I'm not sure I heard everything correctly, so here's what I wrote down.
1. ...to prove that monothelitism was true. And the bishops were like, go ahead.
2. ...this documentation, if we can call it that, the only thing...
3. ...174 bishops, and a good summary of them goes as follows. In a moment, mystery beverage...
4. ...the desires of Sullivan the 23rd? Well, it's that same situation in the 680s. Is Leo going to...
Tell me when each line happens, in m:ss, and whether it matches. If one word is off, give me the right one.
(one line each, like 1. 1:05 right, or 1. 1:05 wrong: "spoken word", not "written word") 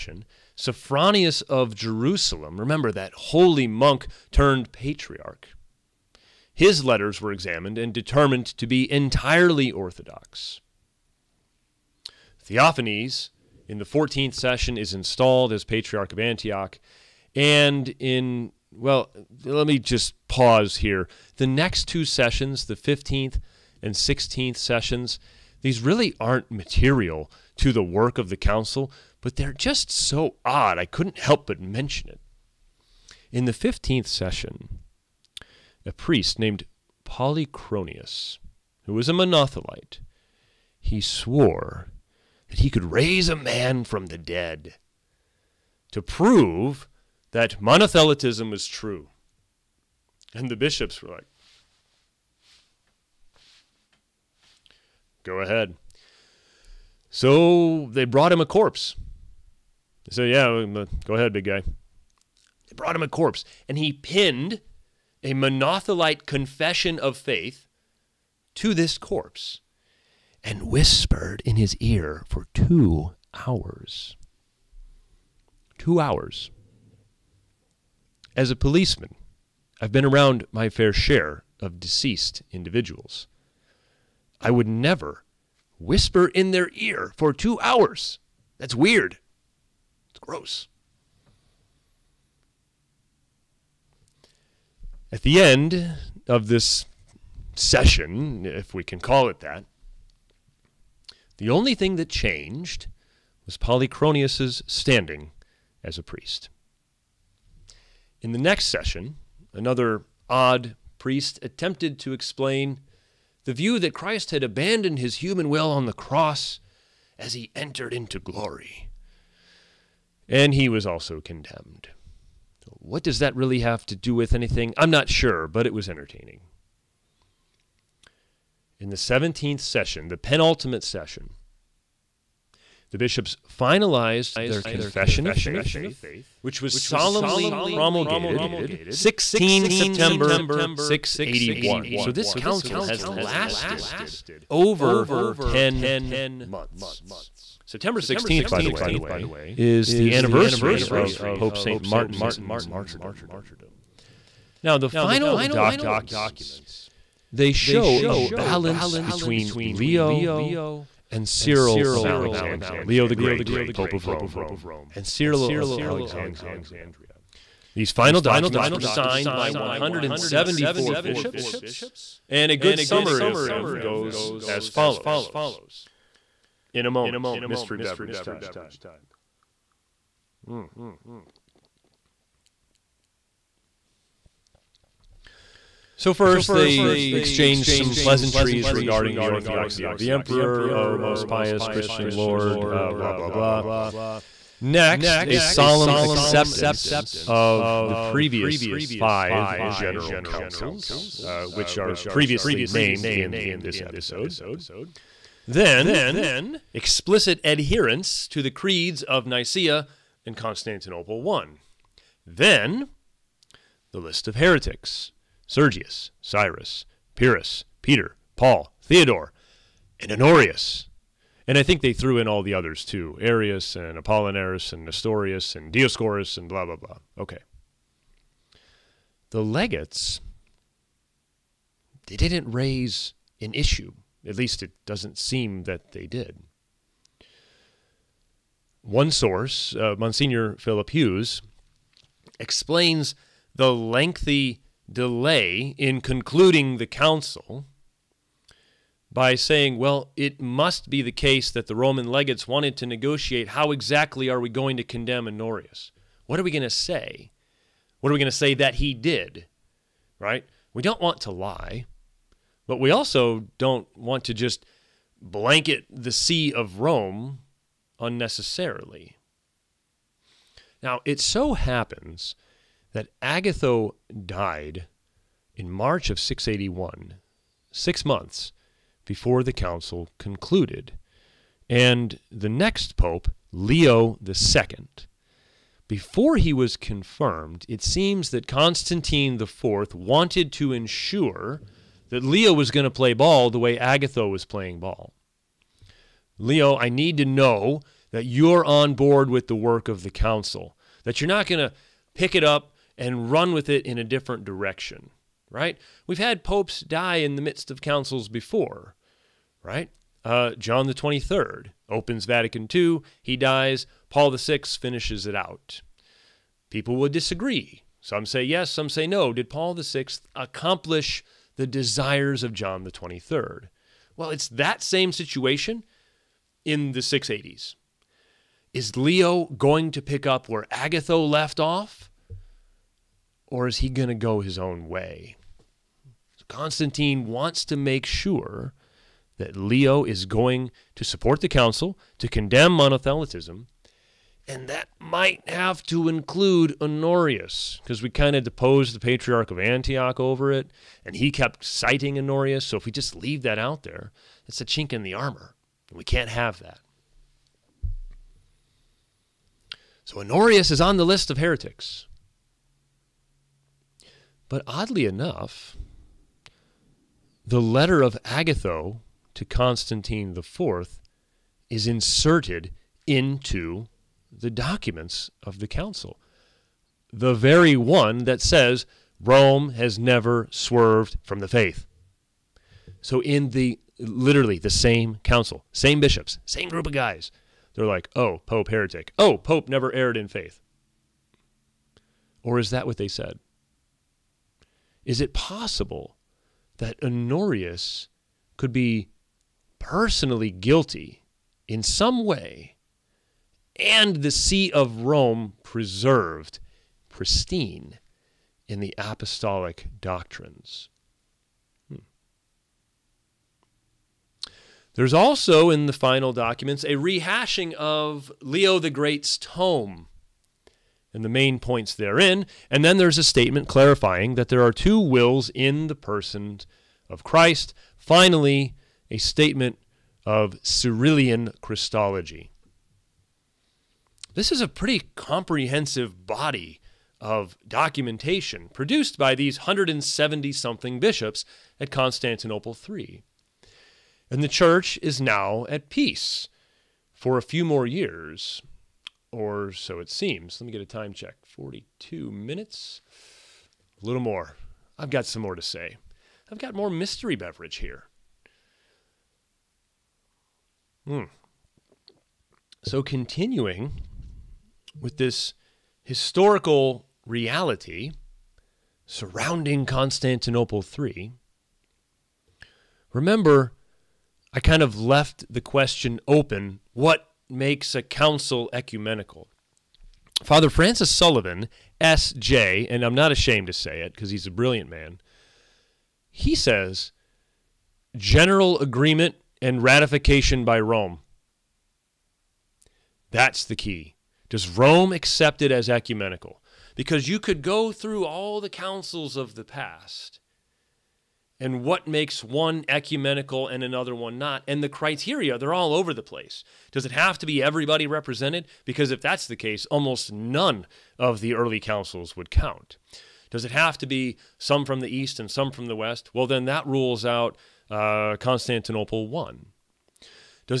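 1. 0:45 right
2. 1:36 wrong: "session", not "documentation"
3. 2:49 right
4. 5:21 wrong: "John", not "Sullivan".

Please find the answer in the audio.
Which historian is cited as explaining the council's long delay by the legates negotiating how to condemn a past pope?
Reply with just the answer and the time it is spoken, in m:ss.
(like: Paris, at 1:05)
Philip Hughes, at 4:00.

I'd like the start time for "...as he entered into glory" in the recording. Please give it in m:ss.
1:57.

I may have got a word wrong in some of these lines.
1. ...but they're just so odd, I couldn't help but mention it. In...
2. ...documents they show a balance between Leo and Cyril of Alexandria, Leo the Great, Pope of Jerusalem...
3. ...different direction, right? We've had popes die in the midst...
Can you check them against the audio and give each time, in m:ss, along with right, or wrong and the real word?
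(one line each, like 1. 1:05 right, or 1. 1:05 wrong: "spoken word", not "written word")
1. 0:29 right
2. 2:35 wrong: "Rome", not "Jerusalem"
3. 5:04 right.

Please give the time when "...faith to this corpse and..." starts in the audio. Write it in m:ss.
1:07.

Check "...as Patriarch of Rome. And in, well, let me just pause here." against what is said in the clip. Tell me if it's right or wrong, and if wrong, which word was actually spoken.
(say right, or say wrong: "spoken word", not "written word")
wrong: "Antioch", not "Rome".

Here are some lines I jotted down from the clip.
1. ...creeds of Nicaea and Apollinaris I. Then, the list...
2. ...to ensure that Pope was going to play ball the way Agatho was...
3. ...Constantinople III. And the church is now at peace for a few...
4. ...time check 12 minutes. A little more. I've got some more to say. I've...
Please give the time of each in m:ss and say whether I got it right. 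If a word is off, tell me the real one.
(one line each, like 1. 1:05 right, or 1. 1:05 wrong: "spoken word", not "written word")
1. 3:28 wrong: "Constantinople", not "Apollinaris"
2. 4:50 wrong: "Leo", not "Pope"
3. 7:21 right
4. 7:30 wrong: "42", not "12".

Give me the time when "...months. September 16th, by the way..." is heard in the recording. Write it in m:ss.
2:26.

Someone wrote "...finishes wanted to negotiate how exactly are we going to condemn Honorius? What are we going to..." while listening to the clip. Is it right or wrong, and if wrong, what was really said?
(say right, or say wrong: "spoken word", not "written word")
wrong: "legates", not "finishes".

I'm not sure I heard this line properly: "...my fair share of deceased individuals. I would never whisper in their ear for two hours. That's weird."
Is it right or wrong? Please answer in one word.
right.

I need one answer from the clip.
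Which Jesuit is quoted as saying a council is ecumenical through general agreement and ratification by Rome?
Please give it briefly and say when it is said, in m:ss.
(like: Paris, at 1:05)
Francis Sullivan, at 8:00.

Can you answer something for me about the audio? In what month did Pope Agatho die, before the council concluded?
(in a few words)
March.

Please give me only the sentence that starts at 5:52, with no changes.
So if we just leave that out there, it's a chink in the armor.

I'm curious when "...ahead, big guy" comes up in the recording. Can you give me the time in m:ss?
1:01.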